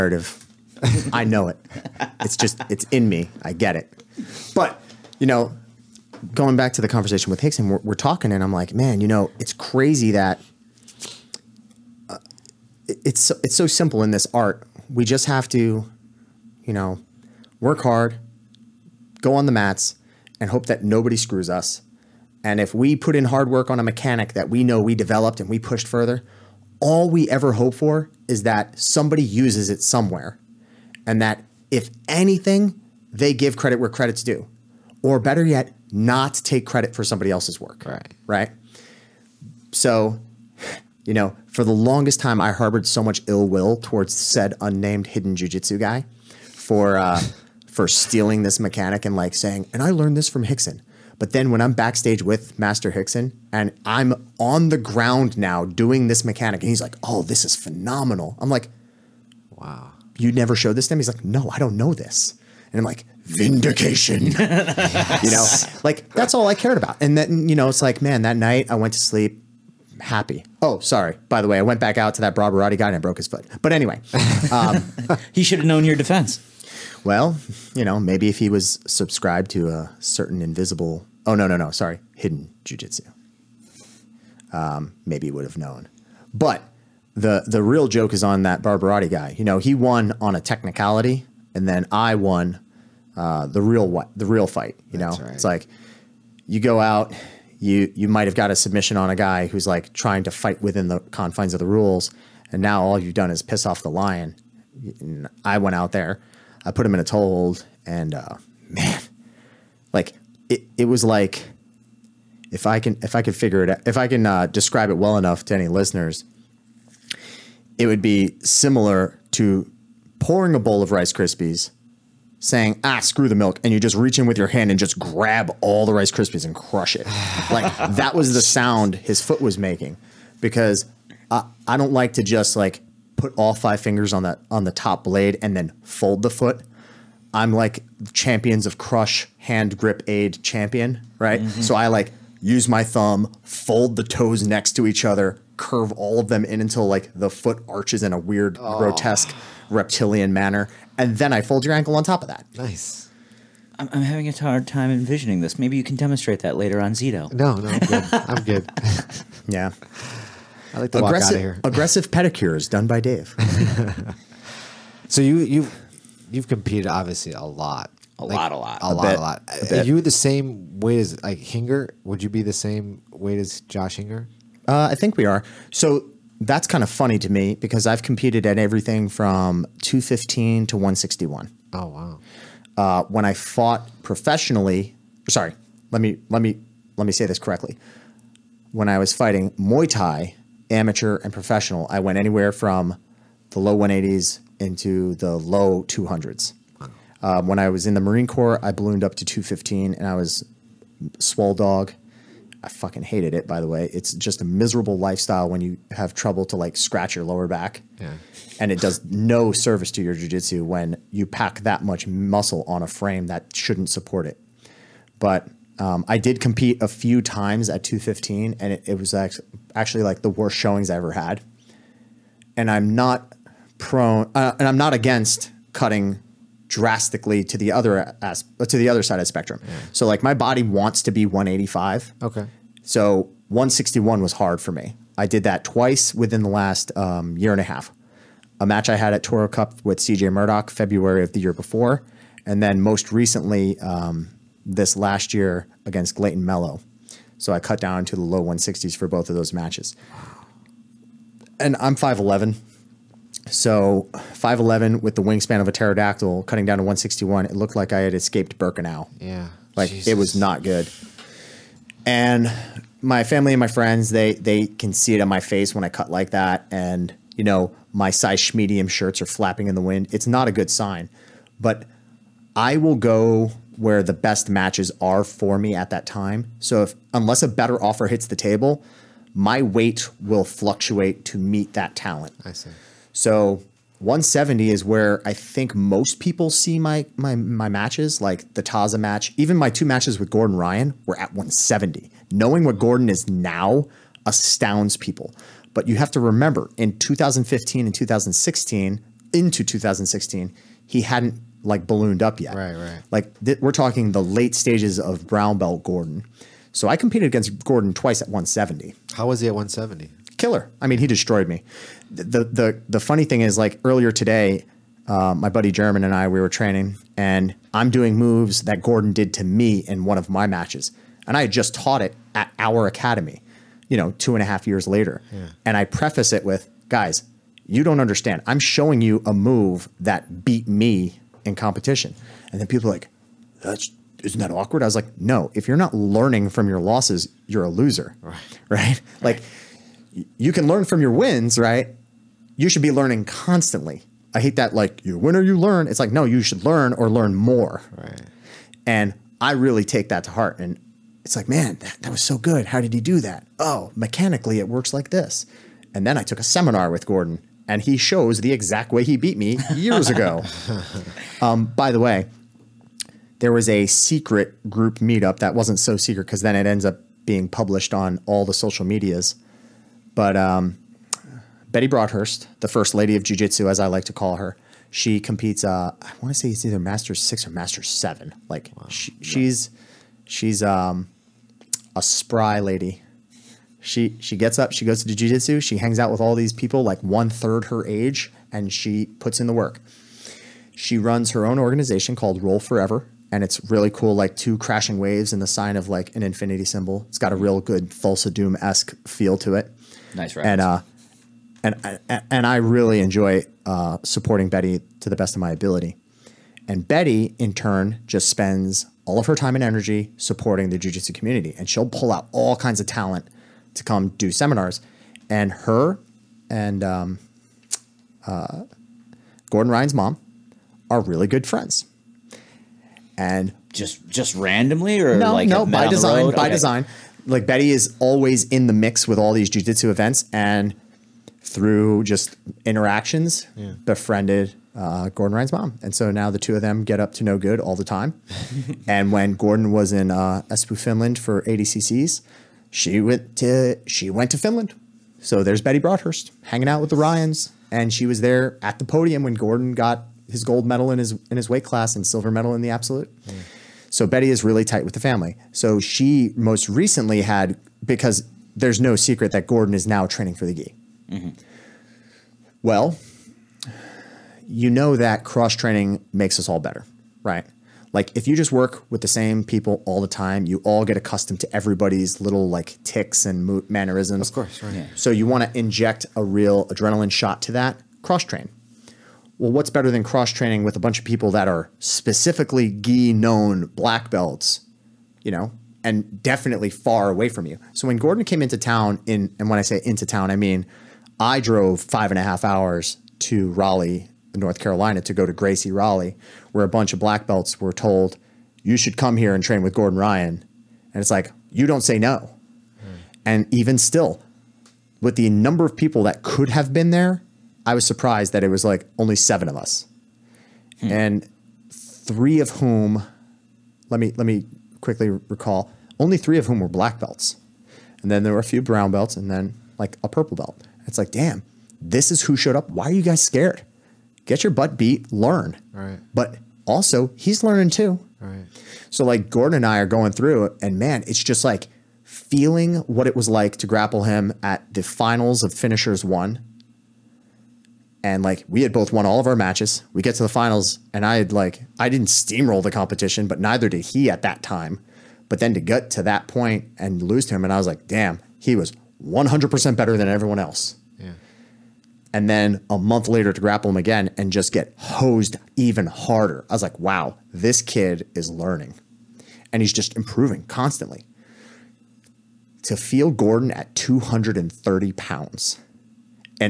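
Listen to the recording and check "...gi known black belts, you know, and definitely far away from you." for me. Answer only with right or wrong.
right.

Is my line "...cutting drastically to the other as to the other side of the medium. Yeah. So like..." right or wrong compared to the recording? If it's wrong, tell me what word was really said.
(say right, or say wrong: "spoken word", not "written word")
wrong: "spectrum", not "medium".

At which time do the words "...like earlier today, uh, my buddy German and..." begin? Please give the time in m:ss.
5:13.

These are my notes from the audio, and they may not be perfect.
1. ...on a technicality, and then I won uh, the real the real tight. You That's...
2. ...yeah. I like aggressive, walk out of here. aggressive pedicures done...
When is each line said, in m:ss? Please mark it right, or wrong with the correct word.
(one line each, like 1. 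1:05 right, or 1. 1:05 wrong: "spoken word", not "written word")
1. 1:30 wrong: "fight", not "tight"
2. 2:39 right.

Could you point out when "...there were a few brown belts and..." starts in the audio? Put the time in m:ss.
8:38.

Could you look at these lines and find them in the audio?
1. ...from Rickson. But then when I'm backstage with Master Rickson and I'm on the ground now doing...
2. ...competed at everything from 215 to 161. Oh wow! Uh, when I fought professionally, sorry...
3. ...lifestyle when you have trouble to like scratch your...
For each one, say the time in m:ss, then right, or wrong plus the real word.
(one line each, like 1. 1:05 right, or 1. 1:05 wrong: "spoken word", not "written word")
1. 0:50 right
2. 2:58 right
3. 3:24 right.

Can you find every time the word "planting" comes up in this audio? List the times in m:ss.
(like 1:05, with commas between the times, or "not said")
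not said.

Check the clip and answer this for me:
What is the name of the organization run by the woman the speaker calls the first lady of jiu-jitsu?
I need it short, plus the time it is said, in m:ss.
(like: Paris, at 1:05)
Roll Forever, at 6:32.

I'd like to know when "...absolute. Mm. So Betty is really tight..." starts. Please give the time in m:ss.
7:32.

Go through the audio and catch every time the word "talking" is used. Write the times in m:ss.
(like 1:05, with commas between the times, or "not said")
0:07, 5:03.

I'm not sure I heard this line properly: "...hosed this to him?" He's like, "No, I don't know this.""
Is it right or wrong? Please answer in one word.
wrong.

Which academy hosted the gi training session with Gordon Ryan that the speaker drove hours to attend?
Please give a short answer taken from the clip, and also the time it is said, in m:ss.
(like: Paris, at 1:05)
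Gracie Raleigh, at 8:15.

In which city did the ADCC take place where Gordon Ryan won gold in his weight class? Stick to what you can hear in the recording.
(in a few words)
Espoo.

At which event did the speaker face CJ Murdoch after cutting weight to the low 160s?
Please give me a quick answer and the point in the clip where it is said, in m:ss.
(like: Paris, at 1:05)
Toro Cup, at 3:59.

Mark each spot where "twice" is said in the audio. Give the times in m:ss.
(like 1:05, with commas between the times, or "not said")
3:55, 5:07.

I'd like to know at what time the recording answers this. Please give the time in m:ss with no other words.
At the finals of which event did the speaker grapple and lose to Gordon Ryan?
8:55.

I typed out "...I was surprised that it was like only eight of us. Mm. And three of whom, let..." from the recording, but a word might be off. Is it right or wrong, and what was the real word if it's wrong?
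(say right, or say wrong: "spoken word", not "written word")
wrong: "seven", not "eight".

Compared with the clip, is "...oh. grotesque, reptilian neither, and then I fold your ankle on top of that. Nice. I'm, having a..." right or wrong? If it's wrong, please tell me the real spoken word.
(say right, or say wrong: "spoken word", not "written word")
wrong: "manner", not "neither".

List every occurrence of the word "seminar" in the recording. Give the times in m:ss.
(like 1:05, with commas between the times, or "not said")
5:56, 6:54.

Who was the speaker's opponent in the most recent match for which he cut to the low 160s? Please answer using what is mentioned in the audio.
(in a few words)
Clayton Mello.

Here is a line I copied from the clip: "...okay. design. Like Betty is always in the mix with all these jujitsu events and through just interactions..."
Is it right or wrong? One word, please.
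right.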